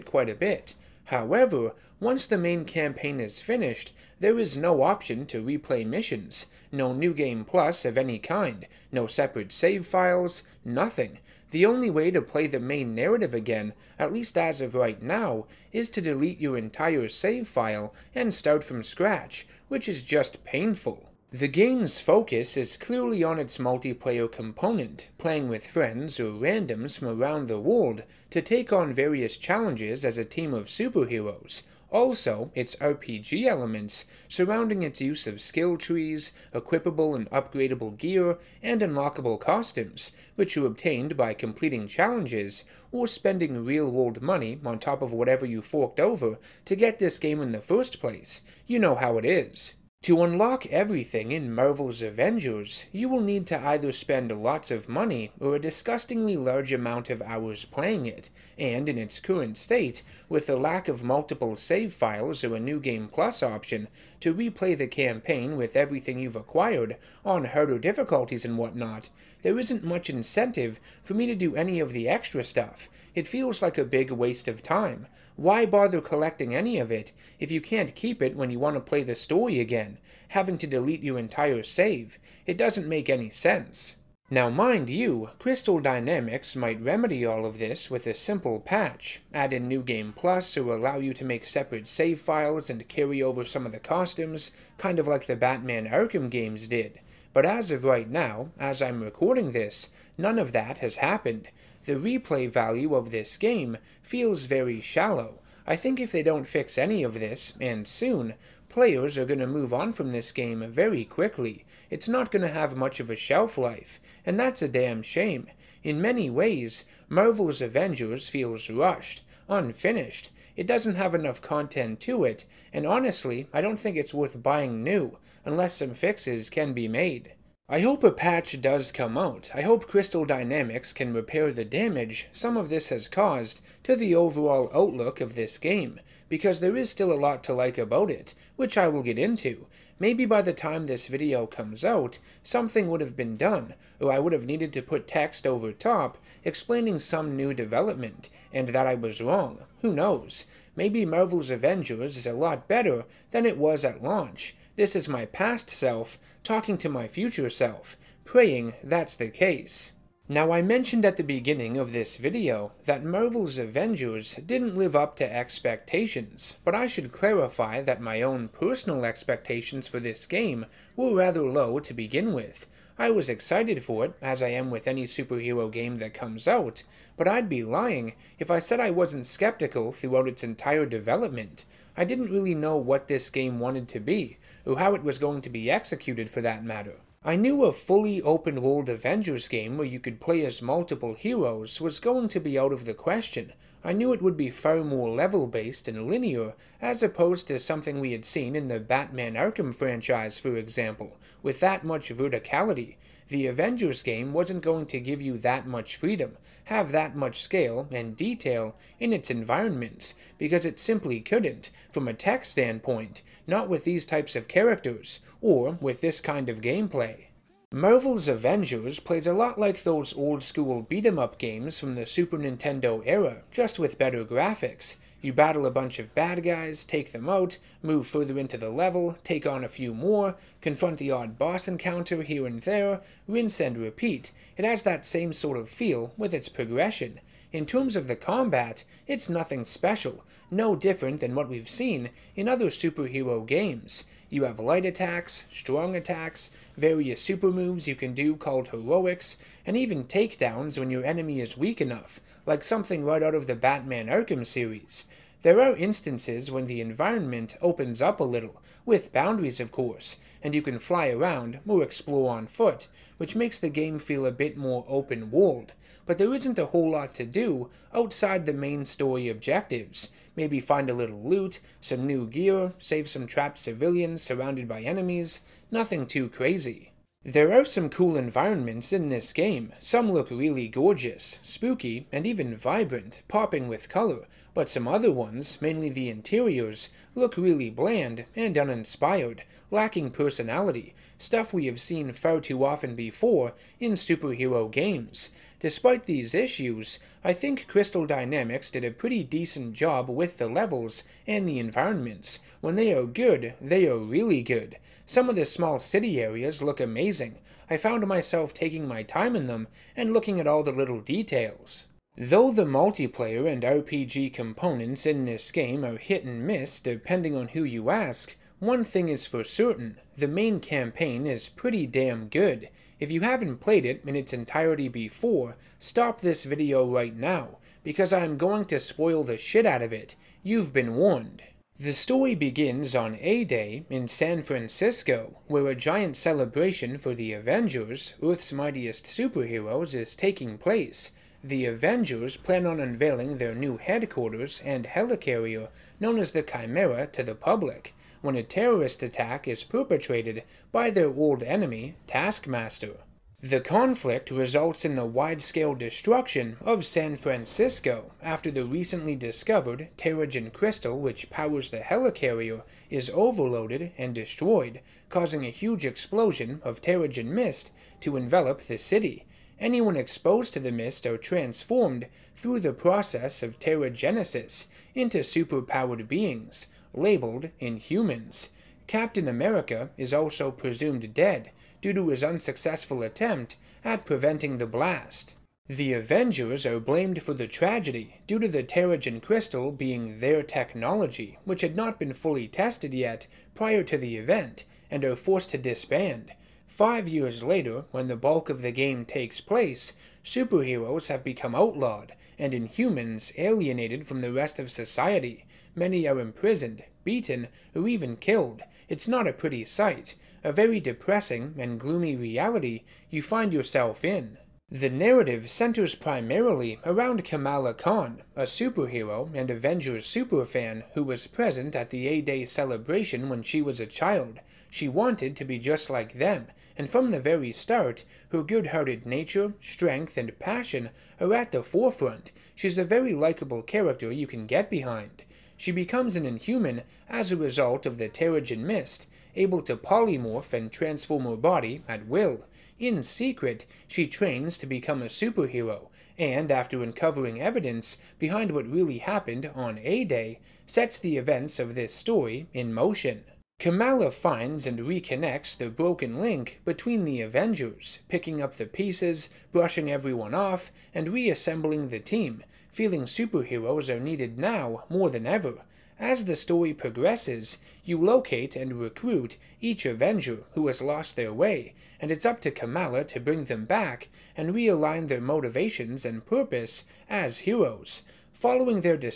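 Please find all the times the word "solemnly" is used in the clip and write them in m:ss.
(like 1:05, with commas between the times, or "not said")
not said.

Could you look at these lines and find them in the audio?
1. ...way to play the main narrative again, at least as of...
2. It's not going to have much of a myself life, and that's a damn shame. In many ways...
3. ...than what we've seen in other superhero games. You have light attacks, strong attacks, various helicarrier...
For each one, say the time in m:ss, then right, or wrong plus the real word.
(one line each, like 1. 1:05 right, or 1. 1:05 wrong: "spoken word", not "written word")
1. 0:11 right
2. 1:51 wrong: "shelf", not "myself"
3. 4:01 wrong: "super", not "helicarrier".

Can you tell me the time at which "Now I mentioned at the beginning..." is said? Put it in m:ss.
2:40.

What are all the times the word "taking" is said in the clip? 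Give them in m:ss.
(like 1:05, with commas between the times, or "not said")
5:08, 5:40.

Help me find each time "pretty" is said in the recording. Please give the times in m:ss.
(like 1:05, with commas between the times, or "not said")
4:58, 5:21, 6:49.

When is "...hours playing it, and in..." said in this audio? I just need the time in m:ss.
0:57.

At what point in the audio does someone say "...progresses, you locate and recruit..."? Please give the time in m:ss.
7:46.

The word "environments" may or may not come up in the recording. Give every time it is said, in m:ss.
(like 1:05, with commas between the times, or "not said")
3:29, 4:16, 4:38, 5:01.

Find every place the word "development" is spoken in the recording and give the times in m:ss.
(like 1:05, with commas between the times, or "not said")
2:27, 3:00.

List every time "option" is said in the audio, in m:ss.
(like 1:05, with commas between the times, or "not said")
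0:04, 1:03.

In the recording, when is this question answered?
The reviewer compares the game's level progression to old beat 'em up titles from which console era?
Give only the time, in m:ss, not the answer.
3:42.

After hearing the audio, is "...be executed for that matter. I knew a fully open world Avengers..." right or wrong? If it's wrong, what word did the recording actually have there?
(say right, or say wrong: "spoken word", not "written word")
right.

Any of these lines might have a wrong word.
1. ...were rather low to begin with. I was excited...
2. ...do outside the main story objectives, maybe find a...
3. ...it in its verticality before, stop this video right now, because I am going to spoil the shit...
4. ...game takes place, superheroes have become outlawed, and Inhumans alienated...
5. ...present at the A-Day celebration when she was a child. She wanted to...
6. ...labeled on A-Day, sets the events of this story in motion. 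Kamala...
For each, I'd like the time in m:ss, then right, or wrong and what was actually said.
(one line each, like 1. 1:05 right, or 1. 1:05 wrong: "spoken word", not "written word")
1. 2:50 right
2. 4:27 right
3. 5:23 wrong: "entirety", not "verticality"
4. 6:38 right
5. 7:01 right
6. 7:28 wrong: "happened", not "labeled".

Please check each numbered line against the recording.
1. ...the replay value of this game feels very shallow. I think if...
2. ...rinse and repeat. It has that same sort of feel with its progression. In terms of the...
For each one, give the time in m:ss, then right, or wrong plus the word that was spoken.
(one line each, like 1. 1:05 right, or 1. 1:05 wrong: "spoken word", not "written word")
1. 1:41 right
2. 3:53 right.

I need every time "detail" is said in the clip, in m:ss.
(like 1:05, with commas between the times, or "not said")
3:28, 5:11.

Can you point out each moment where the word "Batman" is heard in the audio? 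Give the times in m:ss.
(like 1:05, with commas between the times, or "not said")
1:35, 3:18, 4:13.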